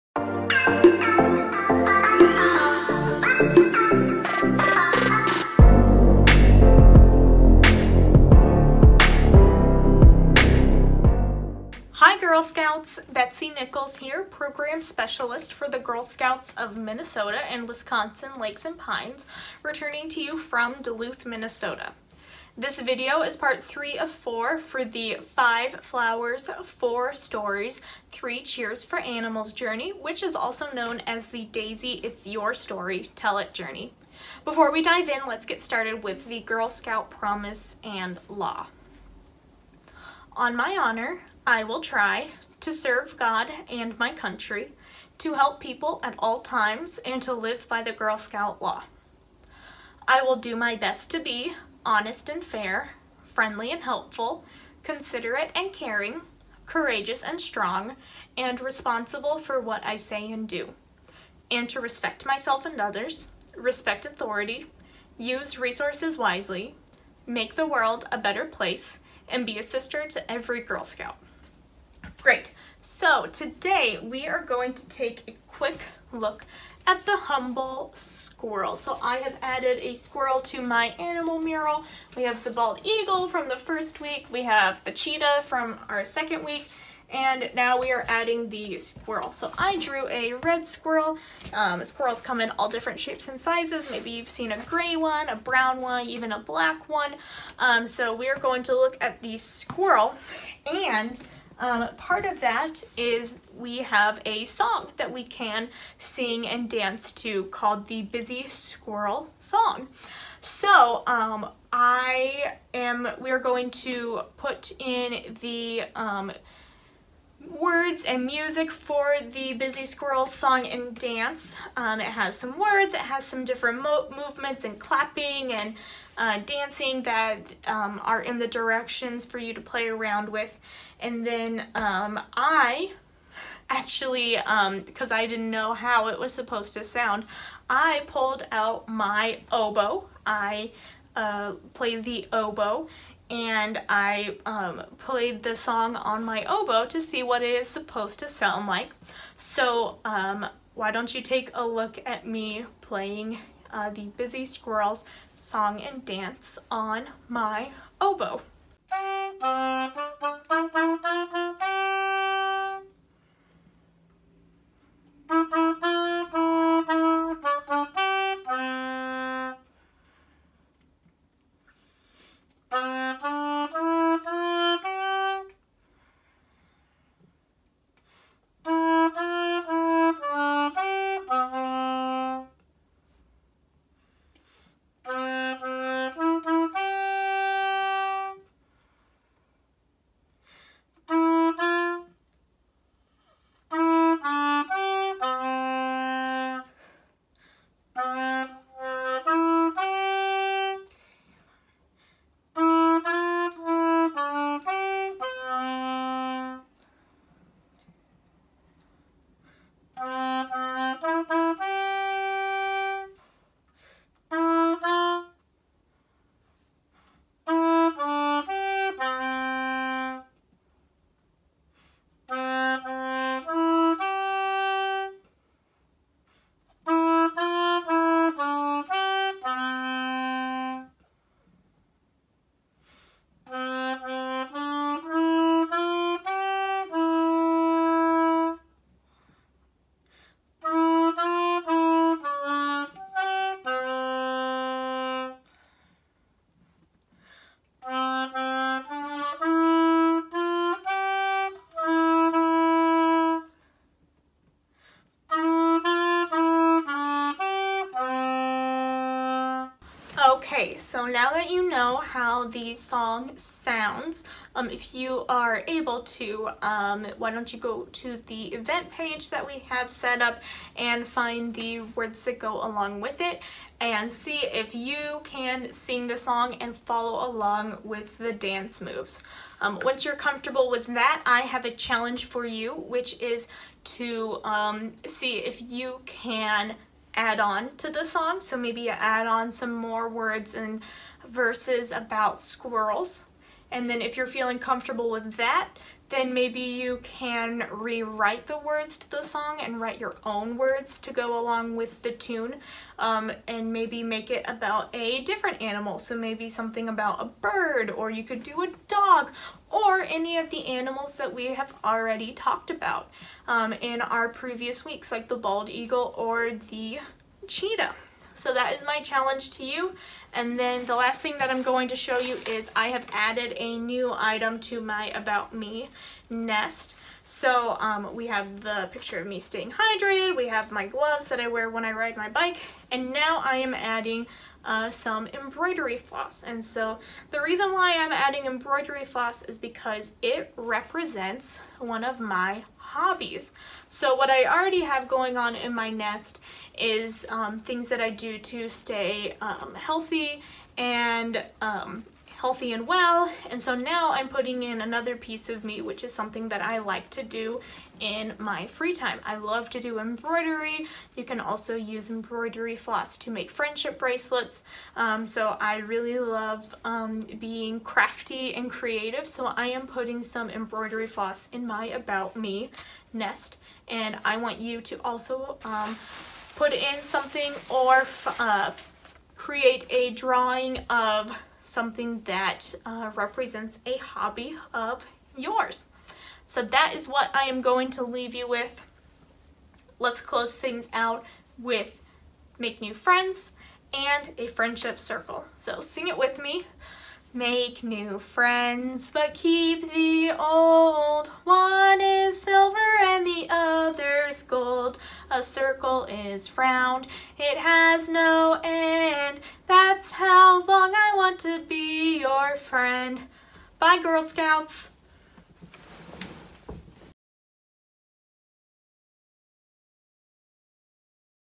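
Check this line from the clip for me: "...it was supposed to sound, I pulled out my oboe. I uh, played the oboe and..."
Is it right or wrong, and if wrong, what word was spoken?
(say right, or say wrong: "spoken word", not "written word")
right.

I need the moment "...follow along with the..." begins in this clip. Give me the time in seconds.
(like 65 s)
276 s.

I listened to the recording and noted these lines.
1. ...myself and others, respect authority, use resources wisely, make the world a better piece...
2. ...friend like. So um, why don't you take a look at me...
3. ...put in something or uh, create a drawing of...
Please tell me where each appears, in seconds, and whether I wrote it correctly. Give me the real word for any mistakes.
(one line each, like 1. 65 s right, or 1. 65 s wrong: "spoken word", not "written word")
1. 62 s wrong: "place", not "piece"
2. 148 s wrong: "sound", not "friend"
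3. 376 s right.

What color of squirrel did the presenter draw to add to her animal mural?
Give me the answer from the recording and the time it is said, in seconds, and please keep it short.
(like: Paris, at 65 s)
Red, at 90 s.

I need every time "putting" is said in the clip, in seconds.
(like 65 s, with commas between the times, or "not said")
354 s, 369 s.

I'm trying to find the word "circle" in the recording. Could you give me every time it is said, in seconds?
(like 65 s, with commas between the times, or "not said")
394 s, 405 s.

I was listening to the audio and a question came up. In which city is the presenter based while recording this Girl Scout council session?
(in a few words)
Duluth, Minnesota.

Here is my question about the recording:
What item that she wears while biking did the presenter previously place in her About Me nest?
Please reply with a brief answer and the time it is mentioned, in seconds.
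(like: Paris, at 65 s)
Gloves, at 330 s.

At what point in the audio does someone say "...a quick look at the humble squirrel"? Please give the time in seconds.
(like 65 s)
75 s.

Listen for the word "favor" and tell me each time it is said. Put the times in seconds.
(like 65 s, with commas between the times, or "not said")
not said.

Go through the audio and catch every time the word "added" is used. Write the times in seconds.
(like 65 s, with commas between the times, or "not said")
79 s, 323 s.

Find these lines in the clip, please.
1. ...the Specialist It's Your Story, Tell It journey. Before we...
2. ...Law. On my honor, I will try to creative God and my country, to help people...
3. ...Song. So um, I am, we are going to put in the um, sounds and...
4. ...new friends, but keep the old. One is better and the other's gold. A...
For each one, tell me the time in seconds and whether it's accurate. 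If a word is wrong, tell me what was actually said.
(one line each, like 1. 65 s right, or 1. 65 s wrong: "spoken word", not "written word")
1. 31 s wrong: "Daisy", not "Specialist"
2. 38 s wrong: "serve", not "creative"
3. 109 s wrong: "words", not "sounds"
4. 397 s wrong: "silver", not "better".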